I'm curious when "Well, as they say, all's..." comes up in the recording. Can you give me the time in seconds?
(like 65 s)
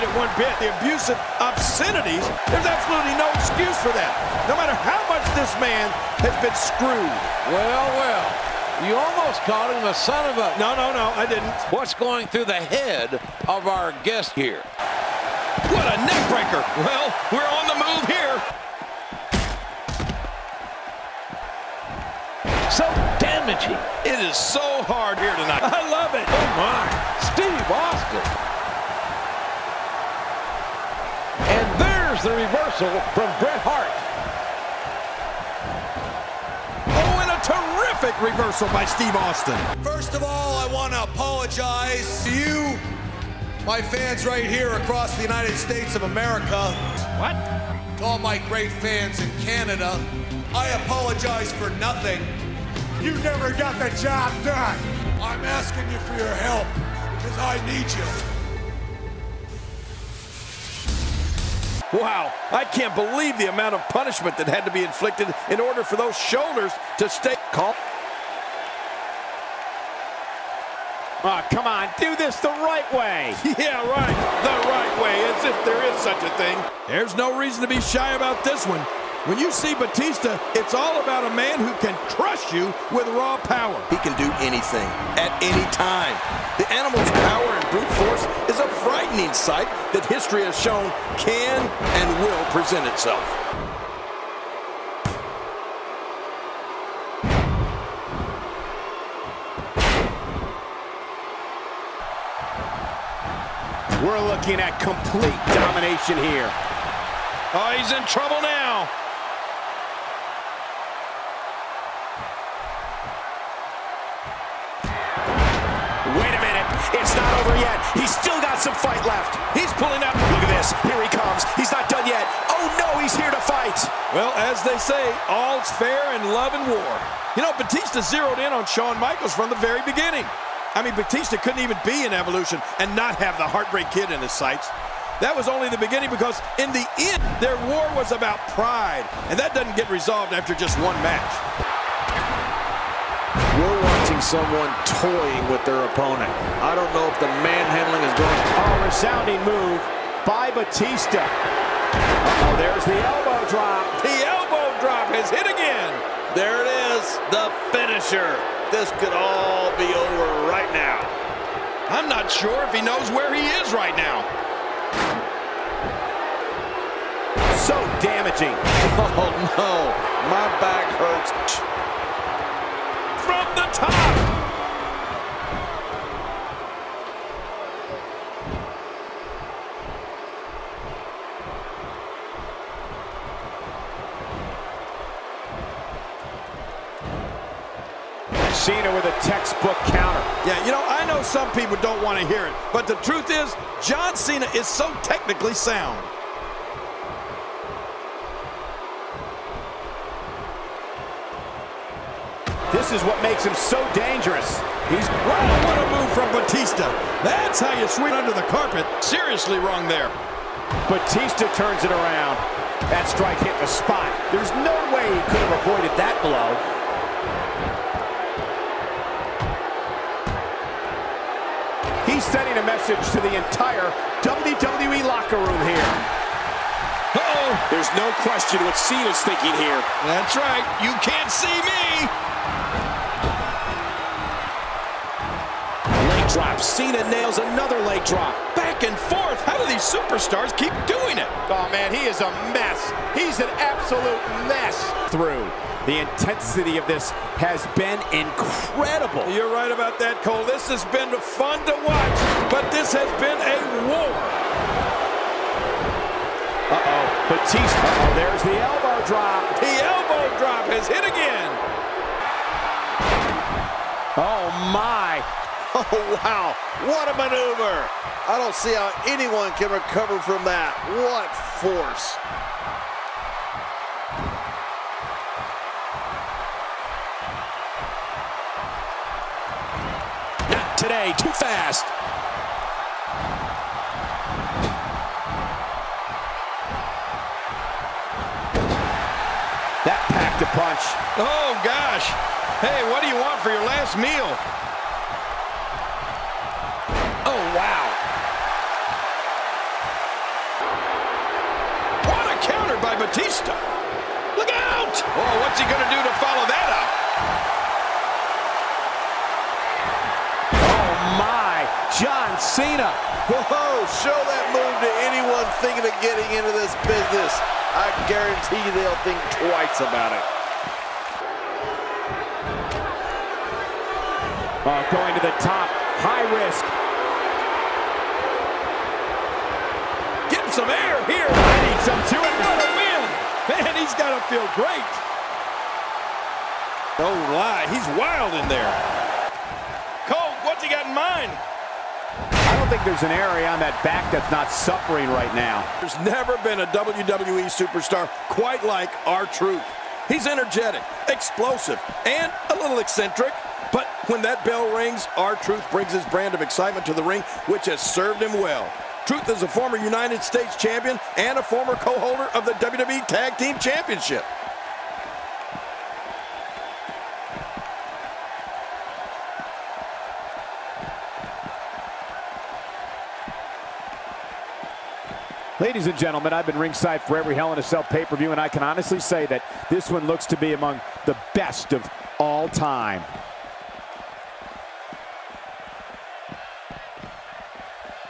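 124 s.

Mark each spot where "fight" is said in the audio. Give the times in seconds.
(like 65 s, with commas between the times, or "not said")
118 s, 123 s.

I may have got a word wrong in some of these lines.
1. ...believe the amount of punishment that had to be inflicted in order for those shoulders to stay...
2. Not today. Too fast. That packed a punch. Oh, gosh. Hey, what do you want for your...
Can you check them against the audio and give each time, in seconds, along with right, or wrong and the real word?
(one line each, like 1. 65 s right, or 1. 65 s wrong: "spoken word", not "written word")
1. 62 s right
2. 280 s right.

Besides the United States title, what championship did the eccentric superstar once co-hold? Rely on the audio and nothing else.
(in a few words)
WWE Tag Team Championship.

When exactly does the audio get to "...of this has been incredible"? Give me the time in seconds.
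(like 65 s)
246 s.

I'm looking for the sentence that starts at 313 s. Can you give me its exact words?
Whoa, show that move to anyone thinking of getting into this business.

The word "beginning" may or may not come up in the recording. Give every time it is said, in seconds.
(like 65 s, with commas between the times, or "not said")
129 s, 135 s.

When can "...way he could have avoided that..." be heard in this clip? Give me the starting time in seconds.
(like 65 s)
214 s.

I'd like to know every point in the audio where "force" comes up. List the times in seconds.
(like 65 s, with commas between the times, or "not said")
87 s, 271 s.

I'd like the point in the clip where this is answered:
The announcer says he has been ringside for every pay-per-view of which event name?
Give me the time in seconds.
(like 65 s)
377 s.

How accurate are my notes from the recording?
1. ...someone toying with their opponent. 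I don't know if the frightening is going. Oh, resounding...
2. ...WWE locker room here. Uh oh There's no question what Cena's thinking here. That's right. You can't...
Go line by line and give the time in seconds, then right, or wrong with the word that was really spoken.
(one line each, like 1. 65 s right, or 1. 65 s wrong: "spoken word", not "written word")
1. 144 s wrong: "manhandling", not "frightening"
2. 224 s right.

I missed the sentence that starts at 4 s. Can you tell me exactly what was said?
No matter how much this man has been screwed.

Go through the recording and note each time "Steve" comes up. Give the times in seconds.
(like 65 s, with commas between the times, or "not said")
27 s, 38 s.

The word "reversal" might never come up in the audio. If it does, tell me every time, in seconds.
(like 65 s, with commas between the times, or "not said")
32 s, 38 s.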